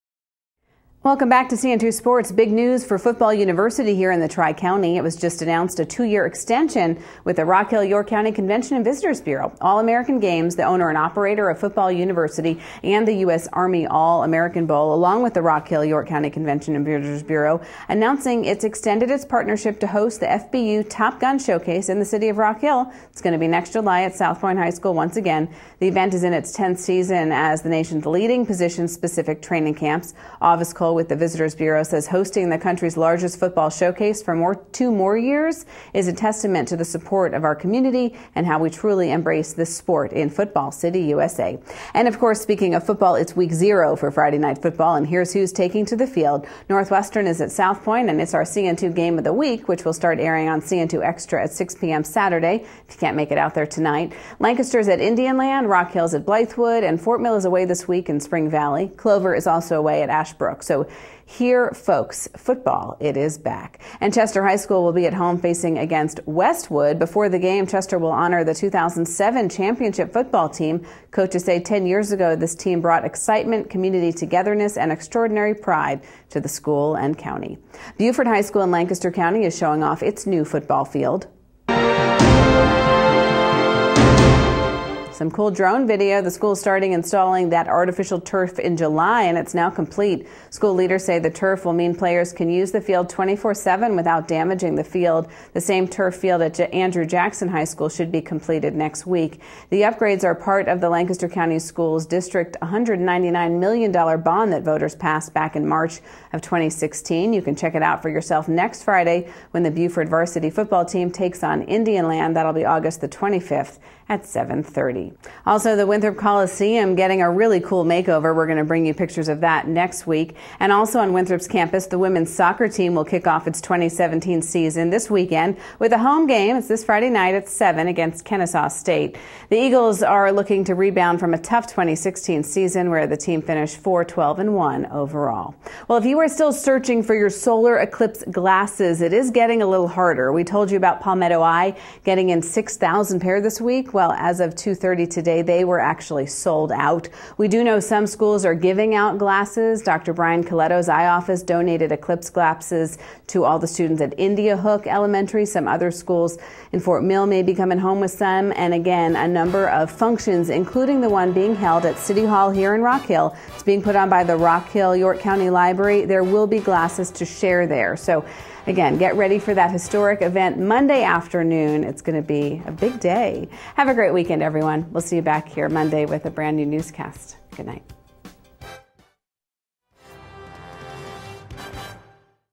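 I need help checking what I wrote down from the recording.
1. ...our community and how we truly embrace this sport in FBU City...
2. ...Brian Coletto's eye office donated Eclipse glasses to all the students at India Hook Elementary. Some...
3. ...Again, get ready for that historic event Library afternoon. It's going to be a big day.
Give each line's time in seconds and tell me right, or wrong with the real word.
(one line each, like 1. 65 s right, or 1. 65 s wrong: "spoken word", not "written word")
1. 37 s wrong: "Football", not "FBU"
2. 150 s right
3. 168 s wrong: "Monday", not "Library".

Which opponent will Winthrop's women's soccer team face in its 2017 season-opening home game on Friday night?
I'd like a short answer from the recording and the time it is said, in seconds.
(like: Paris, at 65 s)
Kennesaw State, at 128 s.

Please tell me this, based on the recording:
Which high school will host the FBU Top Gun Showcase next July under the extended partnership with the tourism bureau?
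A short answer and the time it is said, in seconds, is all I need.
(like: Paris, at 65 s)
South Point High School, at 24 s.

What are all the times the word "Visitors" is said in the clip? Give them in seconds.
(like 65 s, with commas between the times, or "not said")
8 s, 16 s, 31 s.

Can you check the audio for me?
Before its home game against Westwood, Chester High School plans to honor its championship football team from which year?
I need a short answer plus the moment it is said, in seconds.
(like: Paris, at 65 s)
2007, at 68 s.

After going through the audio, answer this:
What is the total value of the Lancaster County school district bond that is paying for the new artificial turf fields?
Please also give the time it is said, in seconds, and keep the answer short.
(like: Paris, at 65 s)
$199 million, at 102 s.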